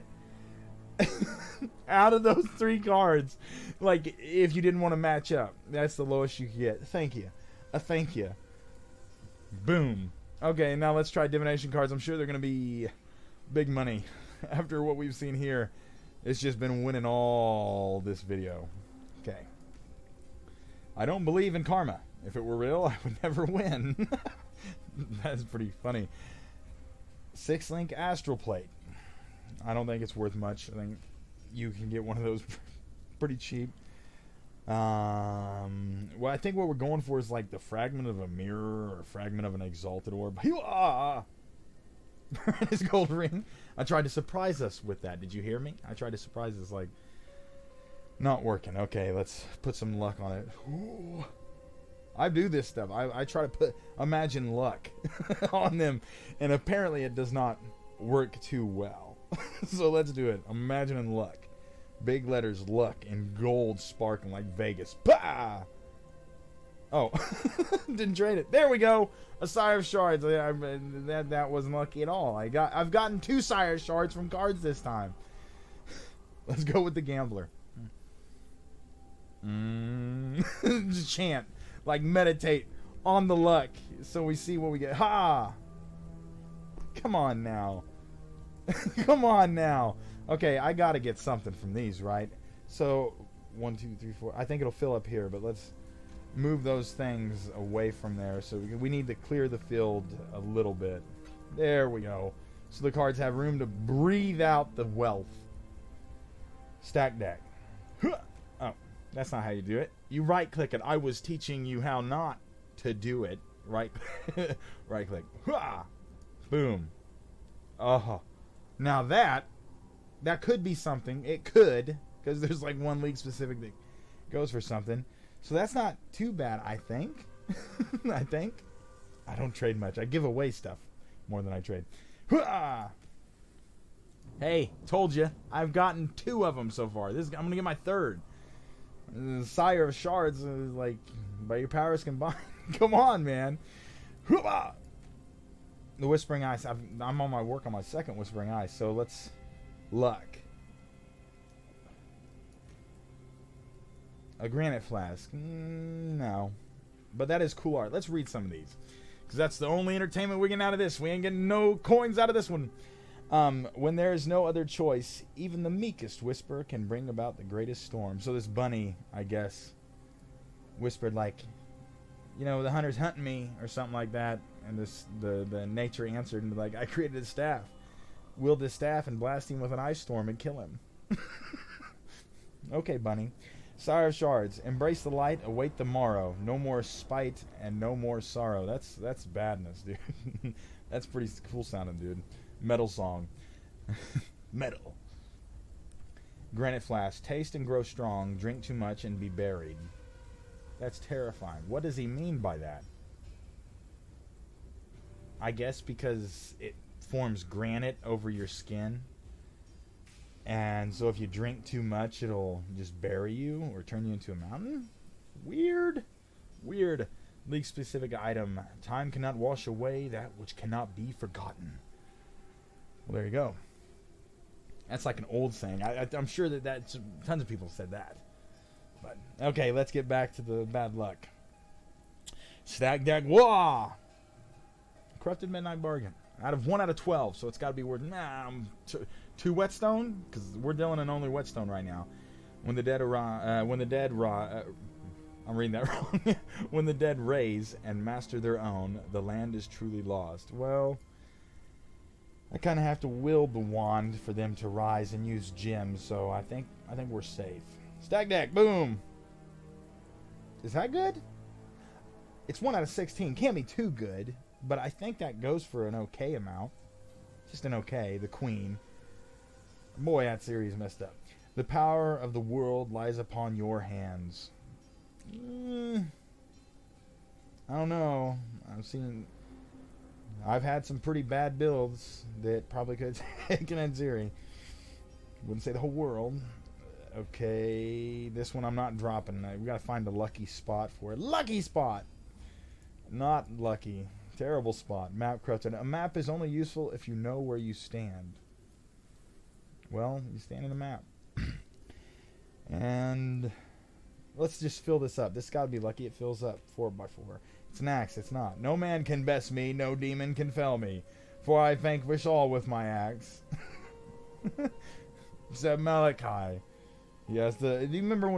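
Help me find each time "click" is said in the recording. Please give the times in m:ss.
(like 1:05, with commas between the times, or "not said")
1:50, 1:55.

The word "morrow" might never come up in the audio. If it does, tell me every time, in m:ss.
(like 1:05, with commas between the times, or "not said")
3:05.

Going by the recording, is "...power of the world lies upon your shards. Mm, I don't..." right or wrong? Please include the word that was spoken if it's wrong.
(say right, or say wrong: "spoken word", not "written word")
wrong: "hands", not "shards".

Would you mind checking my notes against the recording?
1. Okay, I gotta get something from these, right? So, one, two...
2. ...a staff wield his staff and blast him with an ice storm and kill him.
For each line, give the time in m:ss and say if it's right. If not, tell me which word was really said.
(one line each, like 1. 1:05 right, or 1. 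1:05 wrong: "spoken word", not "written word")
1. 1:30 right
2. 2:57 right.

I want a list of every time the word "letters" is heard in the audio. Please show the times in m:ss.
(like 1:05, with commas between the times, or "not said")
1:02.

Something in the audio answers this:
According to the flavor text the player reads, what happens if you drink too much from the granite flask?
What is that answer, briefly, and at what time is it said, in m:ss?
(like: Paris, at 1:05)
Be buried, at 3:19.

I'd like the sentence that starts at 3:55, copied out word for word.
Corrupted midnight bargain out of one out of 12.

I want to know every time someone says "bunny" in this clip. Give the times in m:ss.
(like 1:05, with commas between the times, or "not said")
2:48, 3:02.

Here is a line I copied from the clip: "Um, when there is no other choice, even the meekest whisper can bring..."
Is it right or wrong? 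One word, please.
right.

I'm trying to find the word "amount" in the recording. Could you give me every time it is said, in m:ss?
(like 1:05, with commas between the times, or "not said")
4:26.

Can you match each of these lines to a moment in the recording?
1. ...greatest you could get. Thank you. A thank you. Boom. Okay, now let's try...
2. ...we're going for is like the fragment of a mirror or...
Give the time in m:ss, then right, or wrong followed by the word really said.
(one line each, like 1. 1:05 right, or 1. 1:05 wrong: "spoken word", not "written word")
1. 0:06 wrong: "lowest", not "greatest"
2. 0:36 right.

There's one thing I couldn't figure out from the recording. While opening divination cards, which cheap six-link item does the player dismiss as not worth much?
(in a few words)
Astral plate.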